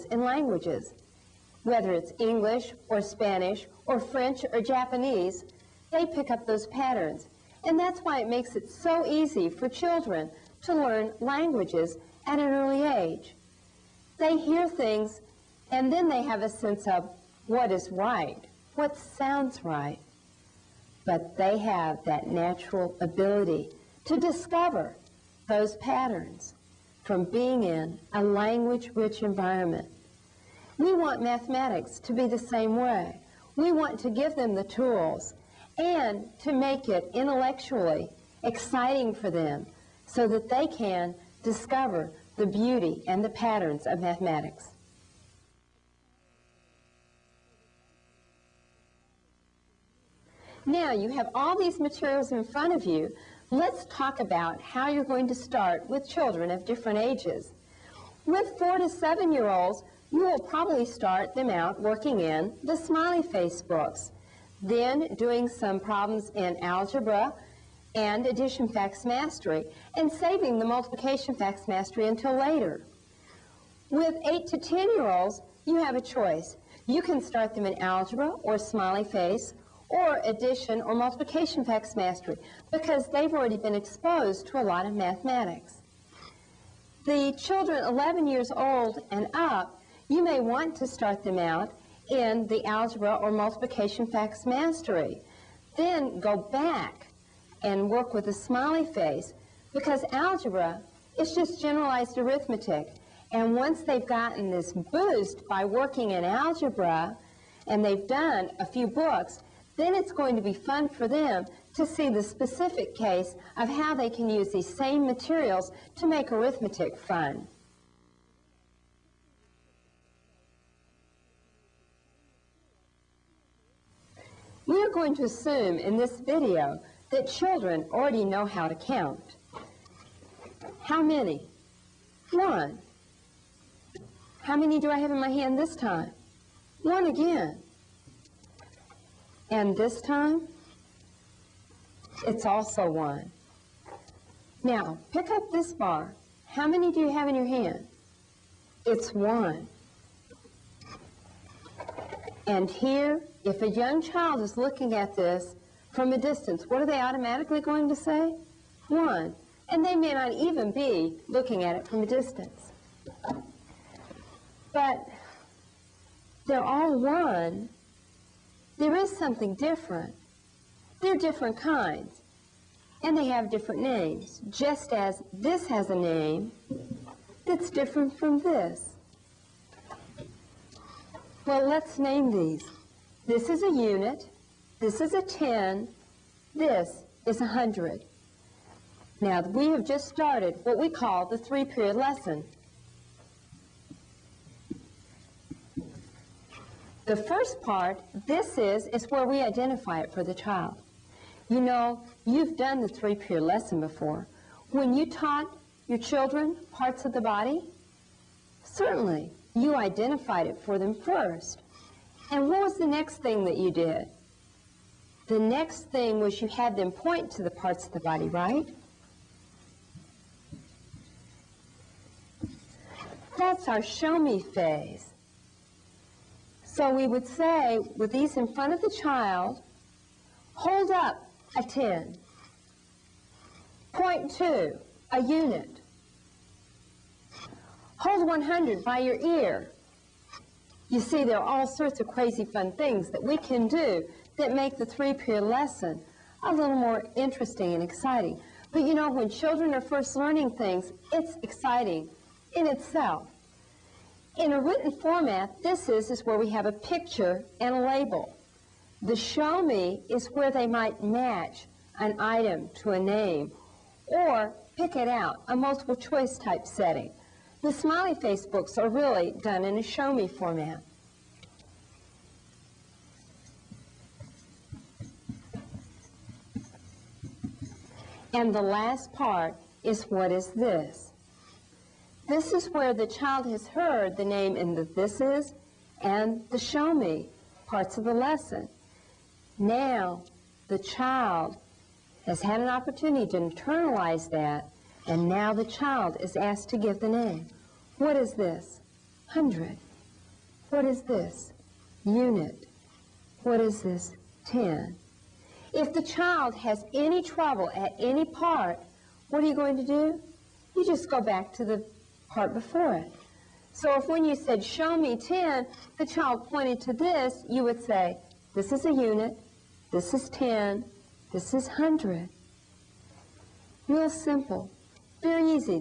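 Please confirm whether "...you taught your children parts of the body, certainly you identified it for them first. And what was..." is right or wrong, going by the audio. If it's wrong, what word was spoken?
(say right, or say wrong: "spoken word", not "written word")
right.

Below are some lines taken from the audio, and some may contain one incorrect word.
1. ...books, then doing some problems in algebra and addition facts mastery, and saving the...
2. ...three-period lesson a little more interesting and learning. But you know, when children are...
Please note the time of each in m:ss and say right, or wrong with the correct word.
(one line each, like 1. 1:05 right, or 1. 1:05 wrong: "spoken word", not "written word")
1. 1:03 right
2. 4:04 wrong: "exciting", not "learning".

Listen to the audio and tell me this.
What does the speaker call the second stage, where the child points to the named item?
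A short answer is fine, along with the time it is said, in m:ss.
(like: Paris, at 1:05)
show me phase, at 3:43.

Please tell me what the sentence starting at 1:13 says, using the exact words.
With 8 to 10 year olds, you have a choice.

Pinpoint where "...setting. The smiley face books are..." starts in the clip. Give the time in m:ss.
4:26.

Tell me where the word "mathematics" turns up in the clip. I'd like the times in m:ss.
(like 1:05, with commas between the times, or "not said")
0:31, 0:43, 1:24.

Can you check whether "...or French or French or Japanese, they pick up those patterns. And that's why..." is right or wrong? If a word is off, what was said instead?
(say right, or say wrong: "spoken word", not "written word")
wrong: "Spanish", not "French".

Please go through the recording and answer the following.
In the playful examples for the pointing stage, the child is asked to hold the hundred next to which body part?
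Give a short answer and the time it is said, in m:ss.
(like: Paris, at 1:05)
ear, at 3:59.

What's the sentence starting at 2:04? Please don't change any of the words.
We are going to assume in this video that children already know how to count.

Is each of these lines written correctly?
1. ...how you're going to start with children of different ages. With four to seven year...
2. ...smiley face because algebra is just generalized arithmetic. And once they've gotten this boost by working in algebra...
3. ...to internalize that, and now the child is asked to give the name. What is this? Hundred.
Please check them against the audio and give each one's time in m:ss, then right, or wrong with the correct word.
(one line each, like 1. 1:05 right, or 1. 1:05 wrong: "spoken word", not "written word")
1. 0:54 right
2. 1:38 right
3. 4:53 right.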